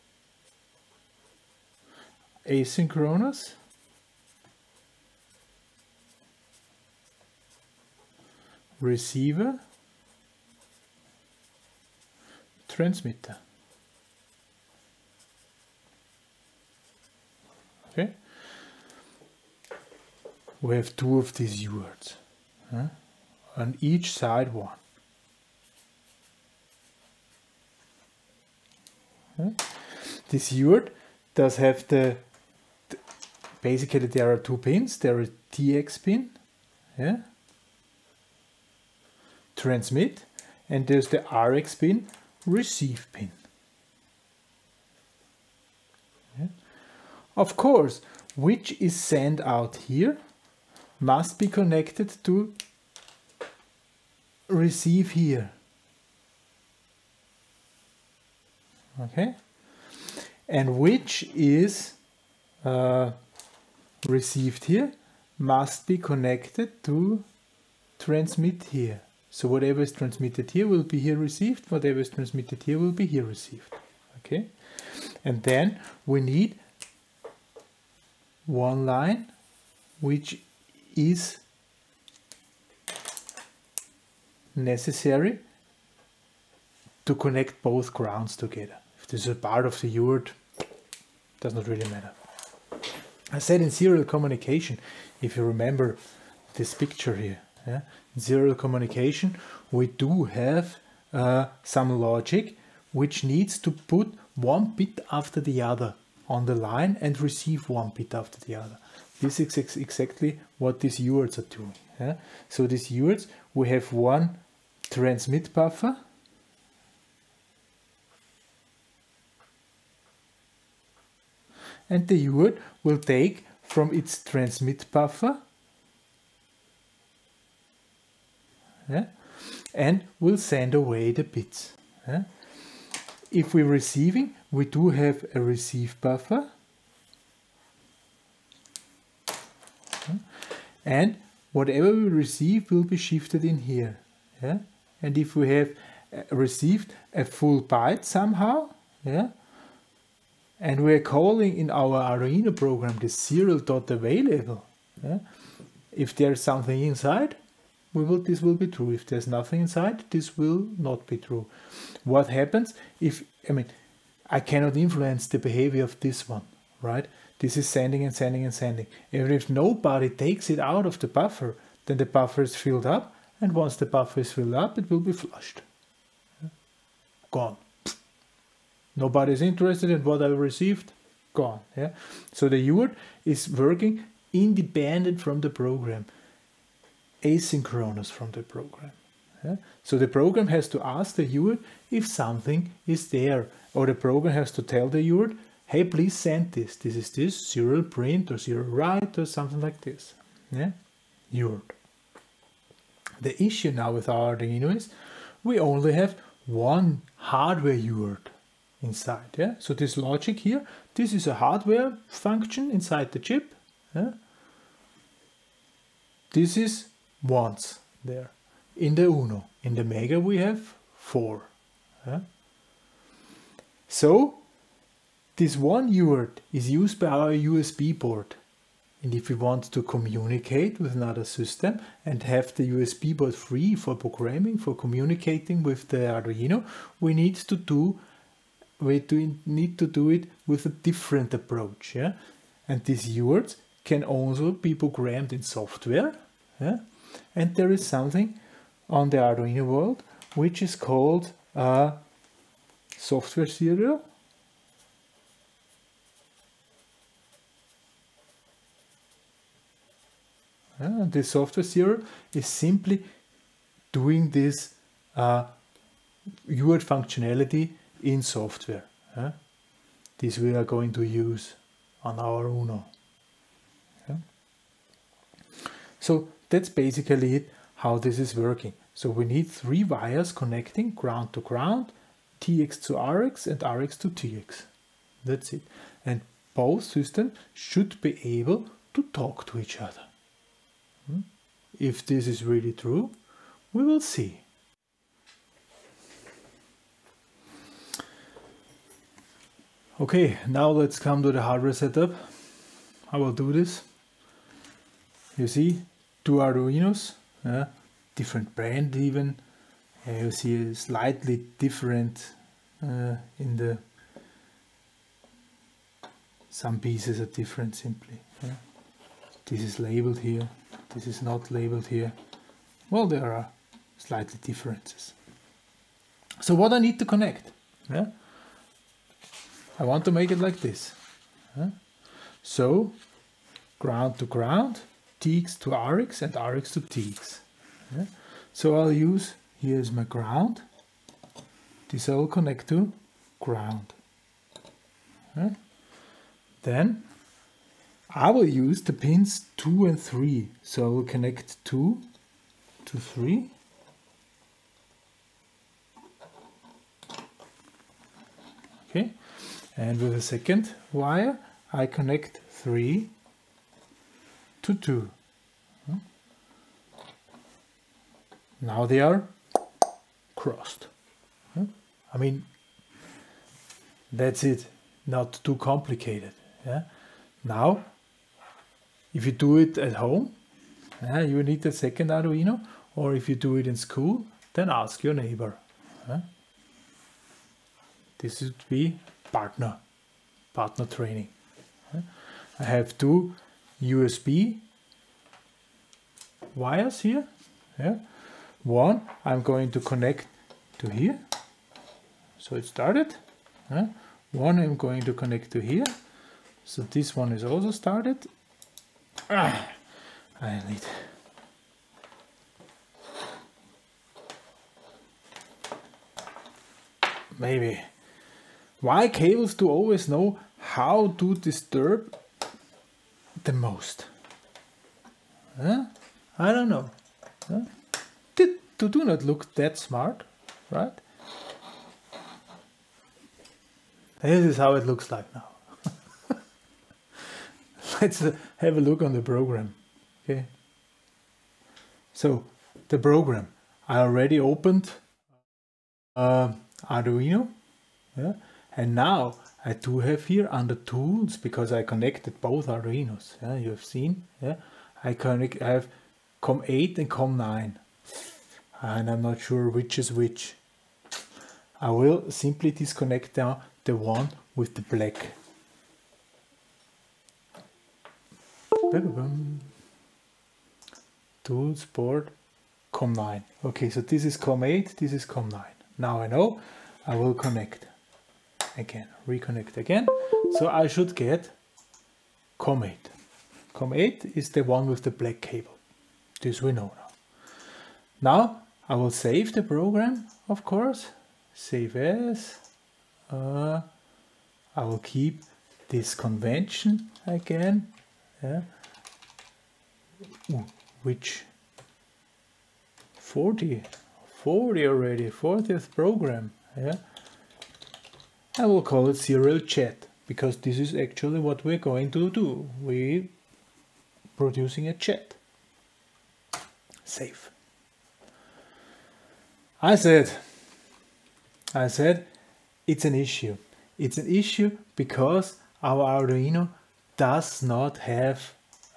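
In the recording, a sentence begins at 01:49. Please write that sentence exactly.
This is ex exactly what these UARTs are doing.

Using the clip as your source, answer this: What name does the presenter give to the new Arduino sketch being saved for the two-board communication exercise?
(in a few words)
Serial chat.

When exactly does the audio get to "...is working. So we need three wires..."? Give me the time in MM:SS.
04:38.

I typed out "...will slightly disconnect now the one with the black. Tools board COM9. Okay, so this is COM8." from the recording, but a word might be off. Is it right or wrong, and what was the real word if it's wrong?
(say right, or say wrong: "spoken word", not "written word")
wrong: "simply", not "slightly".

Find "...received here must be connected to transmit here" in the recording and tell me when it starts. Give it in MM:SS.
01:04.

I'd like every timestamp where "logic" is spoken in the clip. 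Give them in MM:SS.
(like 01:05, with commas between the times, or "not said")
01:41, 03:29.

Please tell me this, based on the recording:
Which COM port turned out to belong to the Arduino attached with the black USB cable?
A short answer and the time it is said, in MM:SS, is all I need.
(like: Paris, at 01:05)
COM8, at 08:03.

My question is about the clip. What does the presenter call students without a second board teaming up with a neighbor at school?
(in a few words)
Partner training.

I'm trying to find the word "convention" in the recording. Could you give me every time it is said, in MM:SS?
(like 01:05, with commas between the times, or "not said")
08:16.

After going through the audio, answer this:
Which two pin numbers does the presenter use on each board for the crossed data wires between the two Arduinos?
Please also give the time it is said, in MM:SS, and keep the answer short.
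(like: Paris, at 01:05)
2 and 3, at 05:48.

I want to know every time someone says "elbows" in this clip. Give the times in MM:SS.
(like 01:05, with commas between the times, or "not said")
not said.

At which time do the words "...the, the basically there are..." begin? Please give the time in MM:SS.
00:31.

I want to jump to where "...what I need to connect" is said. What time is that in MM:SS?
05:26.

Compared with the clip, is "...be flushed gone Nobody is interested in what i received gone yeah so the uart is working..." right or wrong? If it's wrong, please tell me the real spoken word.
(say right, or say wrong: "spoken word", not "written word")
right.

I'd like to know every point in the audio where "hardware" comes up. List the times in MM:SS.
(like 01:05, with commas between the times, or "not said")
03:27, 03:31, 05:01.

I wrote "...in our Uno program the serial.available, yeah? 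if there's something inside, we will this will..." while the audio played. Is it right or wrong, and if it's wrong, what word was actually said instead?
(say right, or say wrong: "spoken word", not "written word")
wrong: "Arduino", not "Uno".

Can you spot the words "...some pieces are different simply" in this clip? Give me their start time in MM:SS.
05:16.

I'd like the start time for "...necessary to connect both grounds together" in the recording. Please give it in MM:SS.
01:24.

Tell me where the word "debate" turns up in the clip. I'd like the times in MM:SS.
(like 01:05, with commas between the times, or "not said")
not said.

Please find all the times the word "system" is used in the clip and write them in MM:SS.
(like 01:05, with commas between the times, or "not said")
03:51, 04:46.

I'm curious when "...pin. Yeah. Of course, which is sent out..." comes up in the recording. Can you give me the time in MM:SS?
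00:43.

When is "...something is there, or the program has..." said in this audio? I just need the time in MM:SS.
03:12.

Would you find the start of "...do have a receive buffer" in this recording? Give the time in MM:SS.
02:14.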